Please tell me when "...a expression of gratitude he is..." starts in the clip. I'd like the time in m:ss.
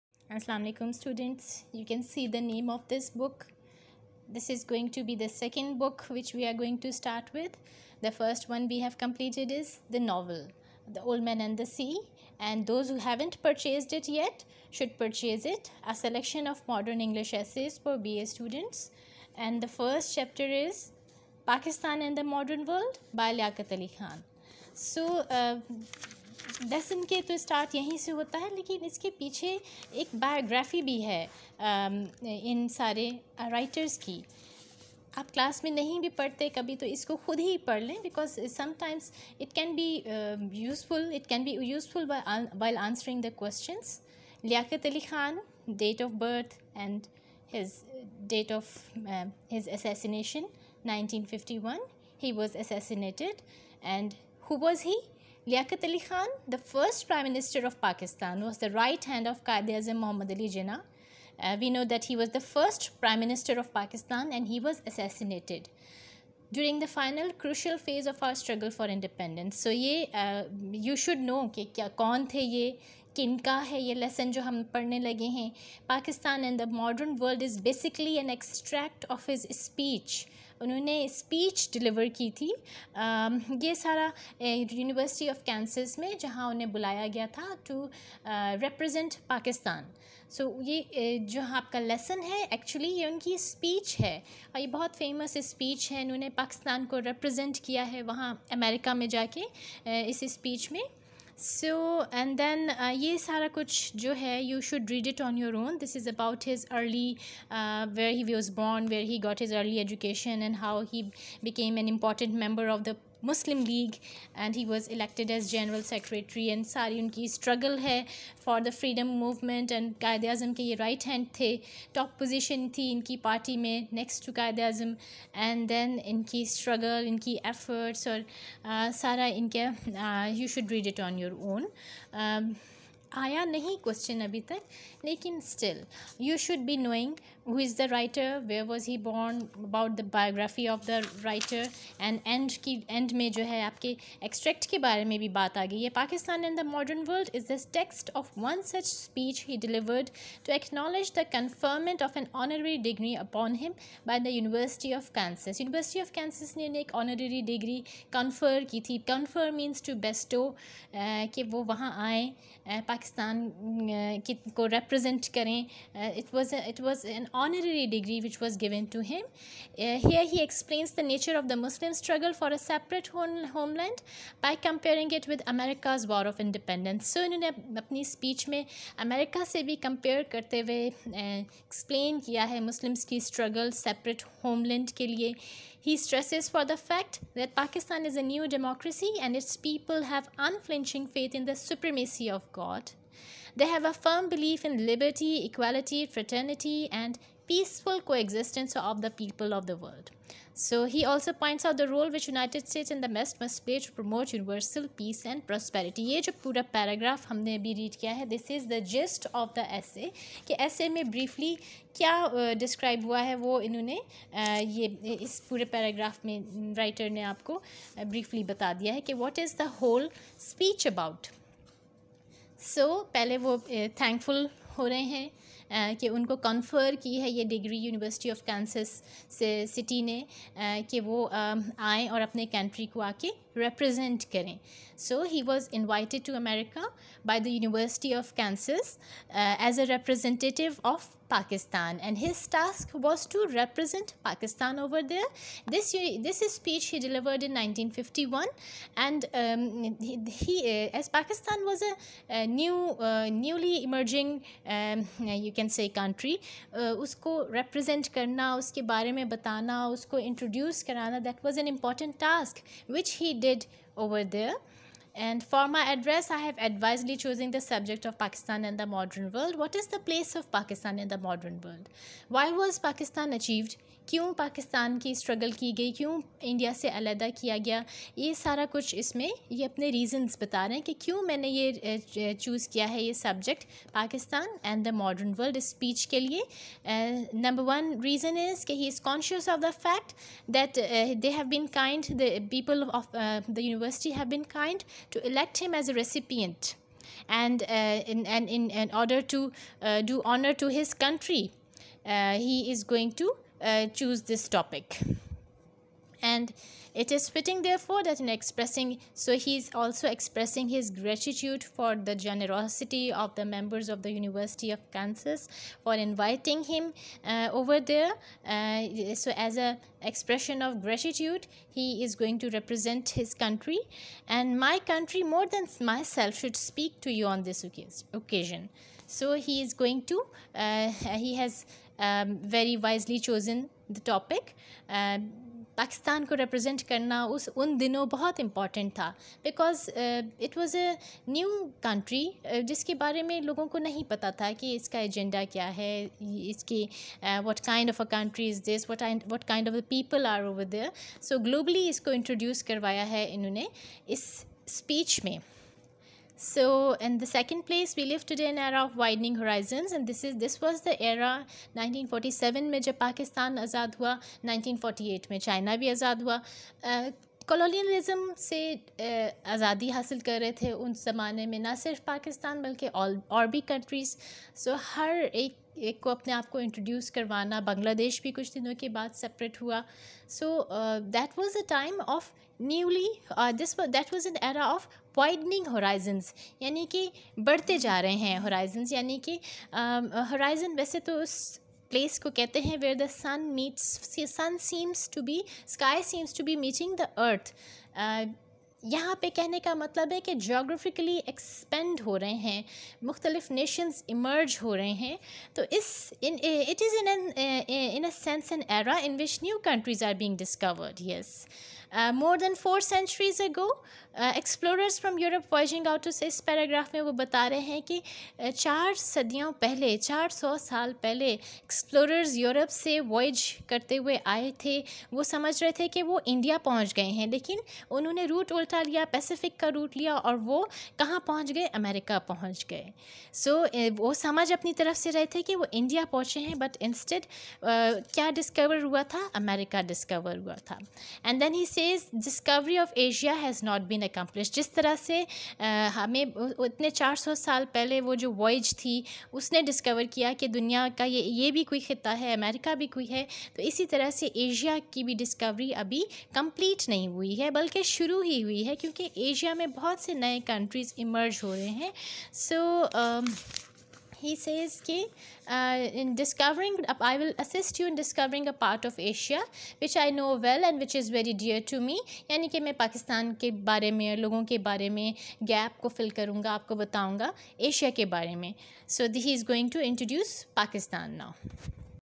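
5:19.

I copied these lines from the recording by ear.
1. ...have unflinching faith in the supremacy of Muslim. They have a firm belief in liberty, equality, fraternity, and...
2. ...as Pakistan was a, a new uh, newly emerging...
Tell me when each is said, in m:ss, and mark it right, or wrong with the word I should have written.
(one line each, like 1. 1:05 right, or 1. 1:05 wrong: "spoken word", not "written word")
1. 3:10 wrong: "God", not "Muslim"
2. 4:10 right.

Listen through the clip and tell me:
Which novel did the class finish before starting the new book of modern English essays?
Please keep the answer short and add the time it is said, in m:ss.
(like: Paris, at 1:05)
The Old Man and the Sea, at 0:10.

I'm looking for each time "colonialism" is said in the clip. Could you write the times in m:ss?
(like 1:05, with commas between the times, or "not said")
6:07.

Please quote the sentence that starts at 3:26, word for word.
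ये जो पूरा पैराग्राफ हमने अभी रीड किया है This is the gist of the essay.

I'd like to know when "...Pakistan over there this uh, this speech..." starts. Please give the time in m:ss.
4:04.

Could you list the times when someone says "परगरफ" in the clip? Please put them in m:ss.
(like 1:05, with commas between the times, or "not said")
3:26, 3:35, 6:56.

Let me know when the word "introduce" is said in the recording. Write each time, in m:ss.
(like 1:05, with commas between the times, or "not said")
4:20, 7:59.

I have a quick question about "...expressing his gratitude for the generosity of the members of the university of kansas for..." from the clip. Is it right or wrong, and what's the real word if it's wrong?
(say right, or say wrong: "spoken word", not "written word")
right.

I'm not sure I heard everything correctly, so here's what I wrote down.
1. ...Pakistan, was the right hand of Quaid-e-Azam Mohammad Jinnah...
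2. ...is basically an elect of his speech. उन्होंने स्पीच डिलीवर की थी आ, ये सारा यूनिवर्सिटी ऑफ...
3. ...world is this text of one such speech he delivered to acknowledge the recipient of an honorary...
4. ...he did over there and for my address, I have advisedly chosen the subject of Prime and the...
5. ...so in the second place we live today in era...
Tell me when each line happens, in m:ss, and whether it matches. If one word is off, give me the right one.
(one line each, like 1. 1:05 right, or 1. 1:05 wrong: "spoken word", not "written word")
1. 0:57 wrong: "Ali", not "Jinnah"
2. 1:17 wrong: "extract", not "elect"
3. 2:27 wrong: "conferment", not "recipient"
4. 4:23 wrong: "Pakistan", not "Prime"
5. 5:56 right.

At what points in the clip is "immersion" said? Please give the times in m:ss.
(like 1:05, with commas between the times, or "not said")
not said.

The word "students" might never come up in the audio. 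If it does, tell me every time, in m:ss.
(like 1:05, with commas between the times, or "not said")
0:00, 0:18.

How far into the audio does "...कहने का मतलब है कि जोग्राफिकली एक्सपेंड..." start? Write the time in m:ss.
6:39.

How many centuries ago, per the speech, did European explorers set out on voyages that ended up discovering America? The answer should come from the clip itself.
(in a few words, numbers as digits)
4.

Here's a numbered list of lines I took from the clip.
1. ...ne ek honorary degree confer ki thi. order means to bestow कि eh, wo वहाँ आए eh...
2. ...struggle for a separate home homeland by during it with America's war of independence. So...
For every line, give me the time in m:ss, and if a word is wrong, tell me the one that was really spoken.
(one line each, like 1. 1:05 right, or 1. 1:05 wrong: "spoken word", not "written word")
1. 2:36 wrong: "confer", not "order"
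2. 2:51 wrong: "comparing", not "during".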